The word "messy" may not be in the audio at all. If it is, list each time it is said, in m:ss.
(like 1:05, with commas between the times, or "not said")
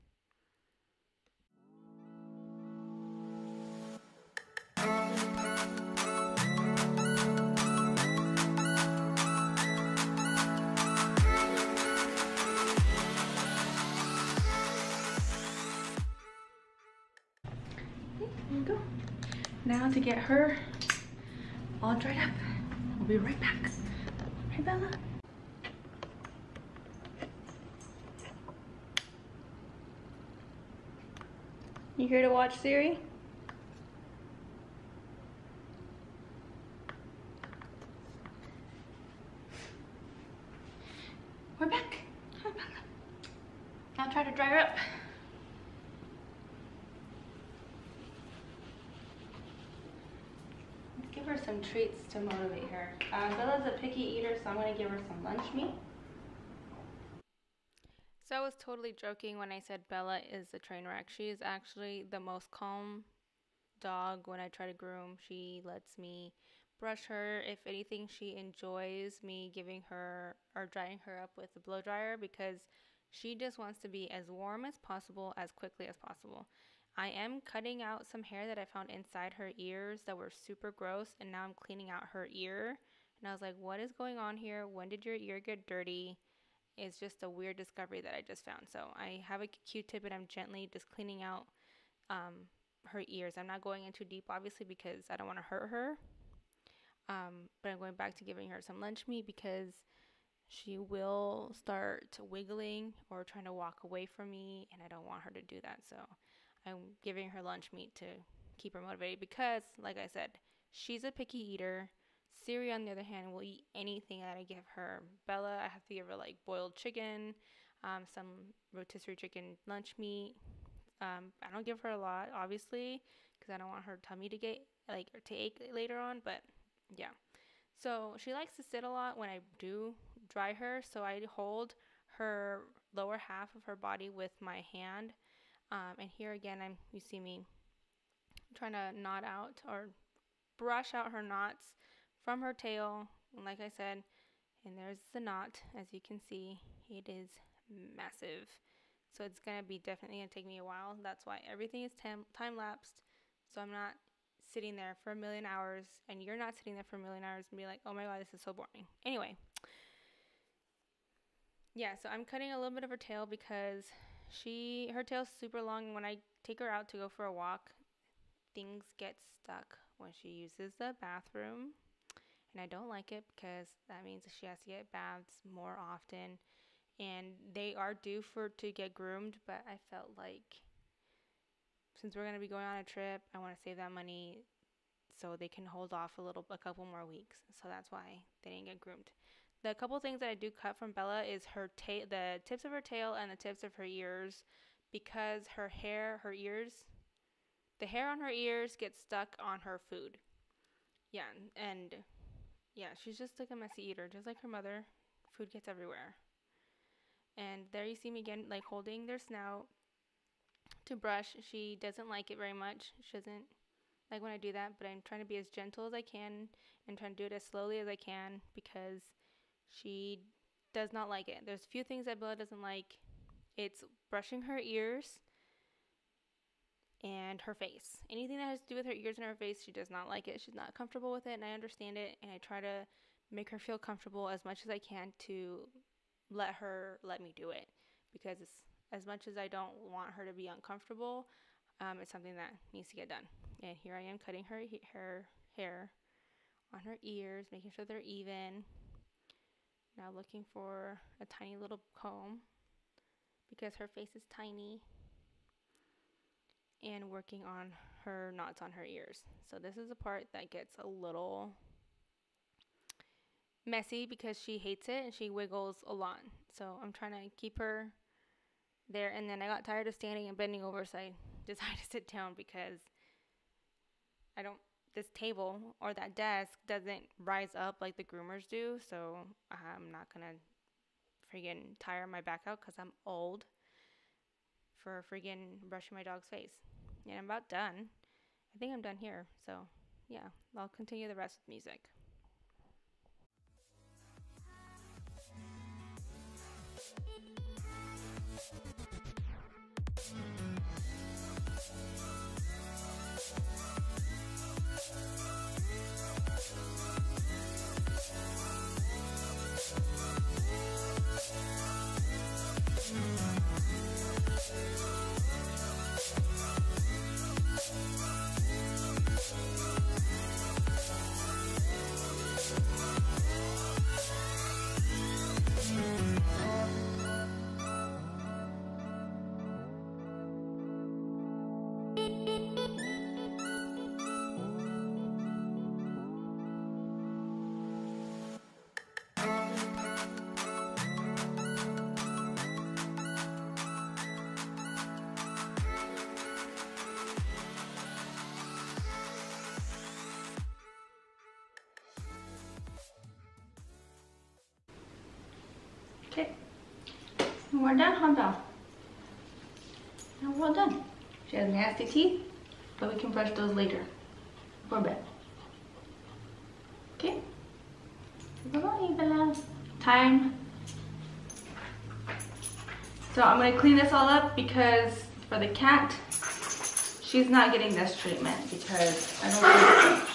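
3:23, 4:23.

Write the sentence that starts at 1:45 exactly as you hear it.
So I'm giving her lunch meat to keep her motivated because, like I said, she's a picky eater.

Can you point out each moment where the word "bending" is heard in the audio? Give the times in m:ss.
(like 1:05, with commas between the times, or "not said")
4:30.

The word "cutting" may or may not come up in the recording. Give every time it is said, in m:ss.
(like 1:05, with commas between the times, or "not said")
1:17, 2:42, 4:04.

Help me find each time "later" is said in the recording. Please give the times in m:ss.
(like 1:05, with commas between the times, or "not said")
2:05, 6:03.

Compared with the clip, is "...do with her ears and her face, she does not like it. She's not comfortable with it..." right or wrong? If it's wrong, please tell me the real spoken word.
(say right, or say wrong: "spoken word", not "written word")
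right.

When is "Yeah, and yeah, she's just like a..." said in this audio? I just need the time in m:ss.
3:21.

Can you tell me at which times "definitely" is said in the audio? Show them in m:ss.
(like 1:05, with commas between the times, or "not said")
2:29.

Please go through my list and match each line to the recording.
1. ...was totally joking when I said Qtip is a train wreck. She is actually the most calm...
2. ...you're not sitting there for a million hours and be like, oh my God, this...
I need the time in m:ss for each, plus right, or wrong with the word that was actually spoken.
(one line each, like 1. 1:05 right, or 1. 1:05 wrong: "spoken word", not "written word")
1. 0:58 wrong: "Bella", not "Qtip"
2. 2:36 right.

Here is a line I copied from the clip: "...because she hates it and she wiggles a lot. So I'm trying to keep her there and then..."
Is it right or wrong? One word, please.
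right.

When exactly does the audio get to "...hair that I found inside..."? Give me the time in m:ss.
1:18.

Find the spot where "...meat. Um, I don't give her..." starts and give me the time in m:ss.
1:59.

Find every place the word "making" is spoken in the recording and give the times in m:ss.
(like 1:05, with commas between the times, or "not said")
4:07.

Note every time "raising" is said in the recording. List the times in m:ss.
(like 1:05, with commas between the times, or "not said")
not said.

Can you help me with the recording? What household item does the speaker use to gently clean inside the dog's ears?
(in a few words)
Q-tip.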